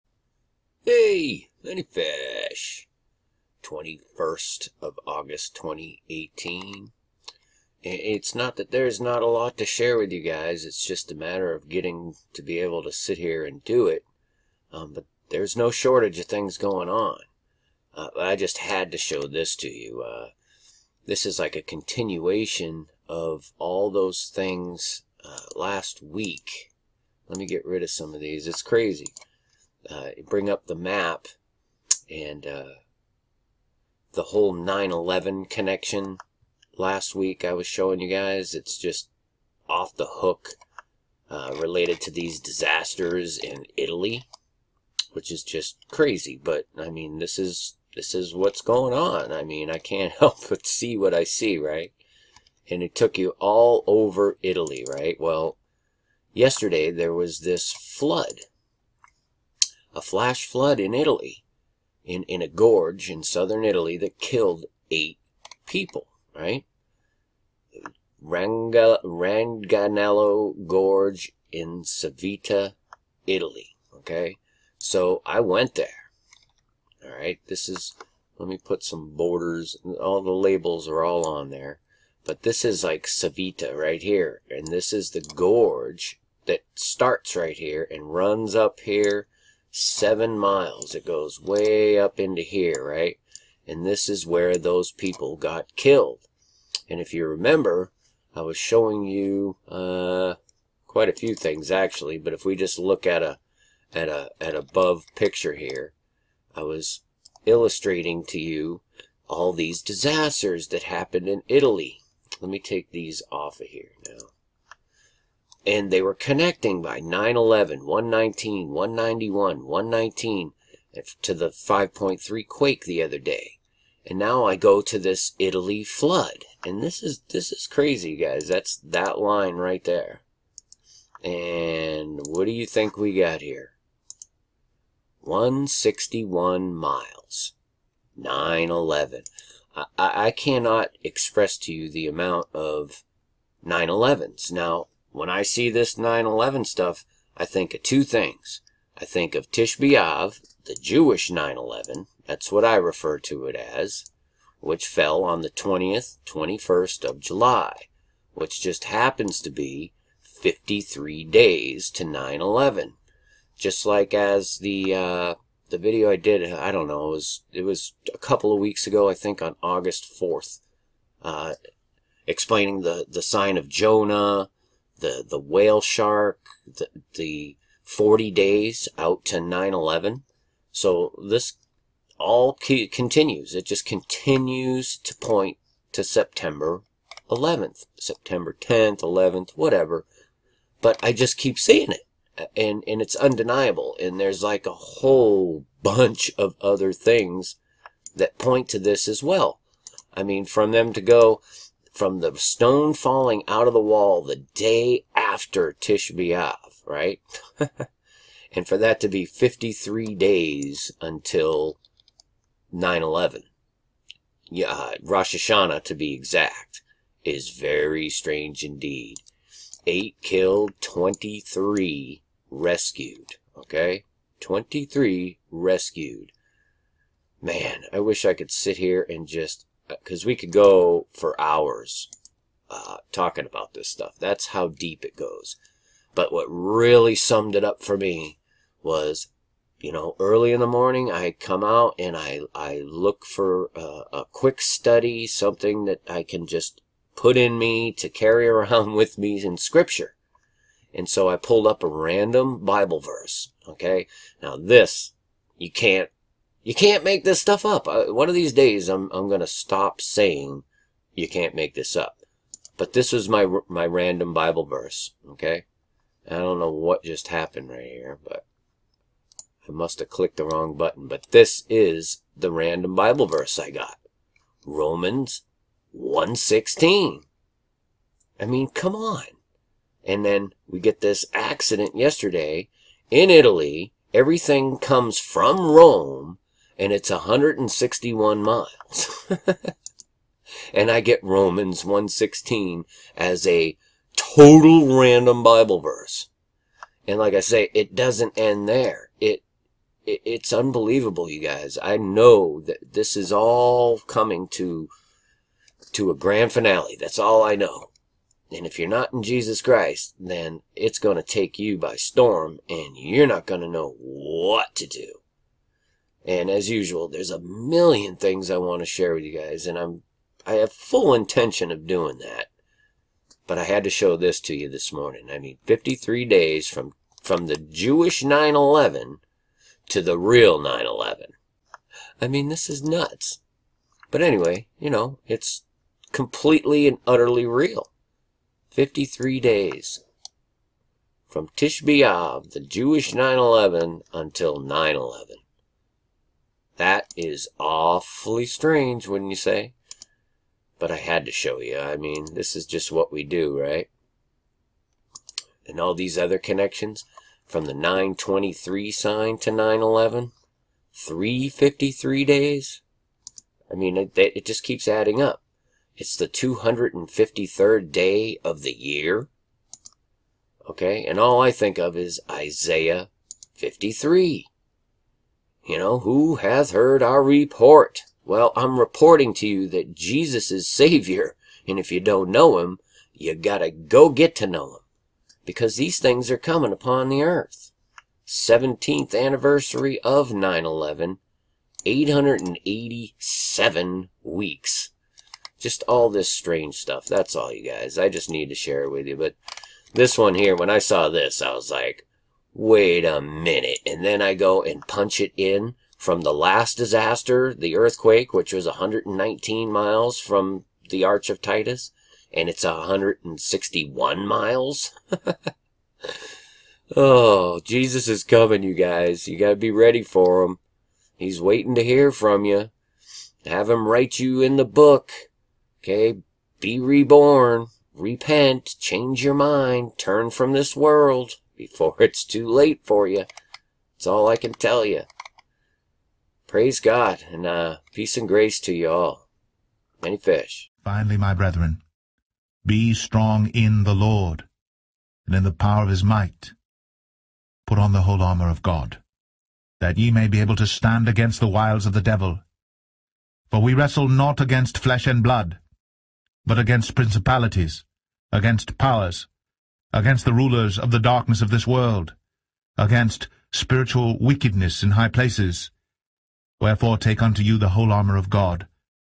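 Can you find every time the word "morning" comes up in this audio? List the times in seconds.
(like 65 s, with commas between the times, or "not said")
240 s, 324 s.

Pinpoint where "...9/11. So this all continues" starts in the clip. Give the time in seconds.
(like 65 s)
179 s.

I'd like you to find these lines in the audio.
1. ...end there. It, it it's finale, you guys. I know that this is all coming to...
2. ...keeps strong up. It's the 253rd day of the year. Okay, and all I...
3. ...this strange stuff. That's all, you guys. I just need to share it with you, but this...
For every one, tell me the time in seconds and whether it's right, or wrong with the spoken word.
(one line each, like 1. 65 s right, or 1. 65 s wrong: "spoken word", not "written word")
1. 298 s wrong: "unbelievable", not "finale"
2. 364 s wrong: "adding", not "strong"
3. 396 s right.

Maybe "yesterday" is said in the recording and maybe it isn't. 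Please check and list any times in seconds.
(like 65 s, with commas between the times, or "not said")
56 s, 281 s.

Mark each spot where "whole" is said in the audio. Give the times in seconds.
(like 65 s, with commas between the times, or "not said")
34 s, 194 s, 448 s, 467 s.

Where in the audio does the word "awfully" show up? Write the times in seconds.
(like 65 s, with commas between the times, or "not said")
347 s.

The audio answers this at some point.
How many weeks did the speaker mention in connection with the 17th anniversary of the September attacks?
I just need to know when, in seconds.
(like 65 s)
391 s.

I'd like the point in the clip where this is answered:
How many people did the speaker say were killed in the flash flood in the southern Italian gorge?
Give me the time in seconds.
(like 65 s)
64 s.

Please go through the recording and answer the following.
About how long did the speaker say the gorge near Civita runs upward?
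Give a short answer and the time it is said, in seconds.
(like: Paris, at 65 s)
7 miles, at 89 s.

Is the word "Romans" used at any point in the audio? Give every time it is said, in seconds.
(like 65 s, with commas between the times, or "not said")
274 s, 291 s.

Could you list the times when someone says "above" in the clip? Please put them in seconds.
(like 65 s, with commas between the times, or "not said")
104 s.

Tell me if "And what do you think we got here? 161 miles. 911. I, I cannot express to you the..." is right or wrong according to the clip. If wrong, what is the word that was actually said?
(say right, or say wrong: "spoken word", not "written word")
right.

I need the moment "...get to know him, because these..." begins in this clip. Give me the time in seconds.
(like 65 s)
384 s.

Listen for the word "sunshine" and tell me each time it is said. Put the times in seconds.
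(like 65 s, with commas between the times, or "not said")
not said.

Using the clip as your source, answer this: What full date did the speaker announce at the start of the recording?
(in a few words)
21st of August 2018.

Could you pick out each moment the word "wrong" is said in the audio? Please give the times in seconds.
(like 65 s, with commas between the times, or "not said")
270 s.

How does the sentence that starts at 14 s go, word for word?
Um, but there's no shortage of things going on.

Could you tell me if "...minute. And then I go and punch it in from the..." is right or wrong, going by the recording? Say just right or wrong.
right.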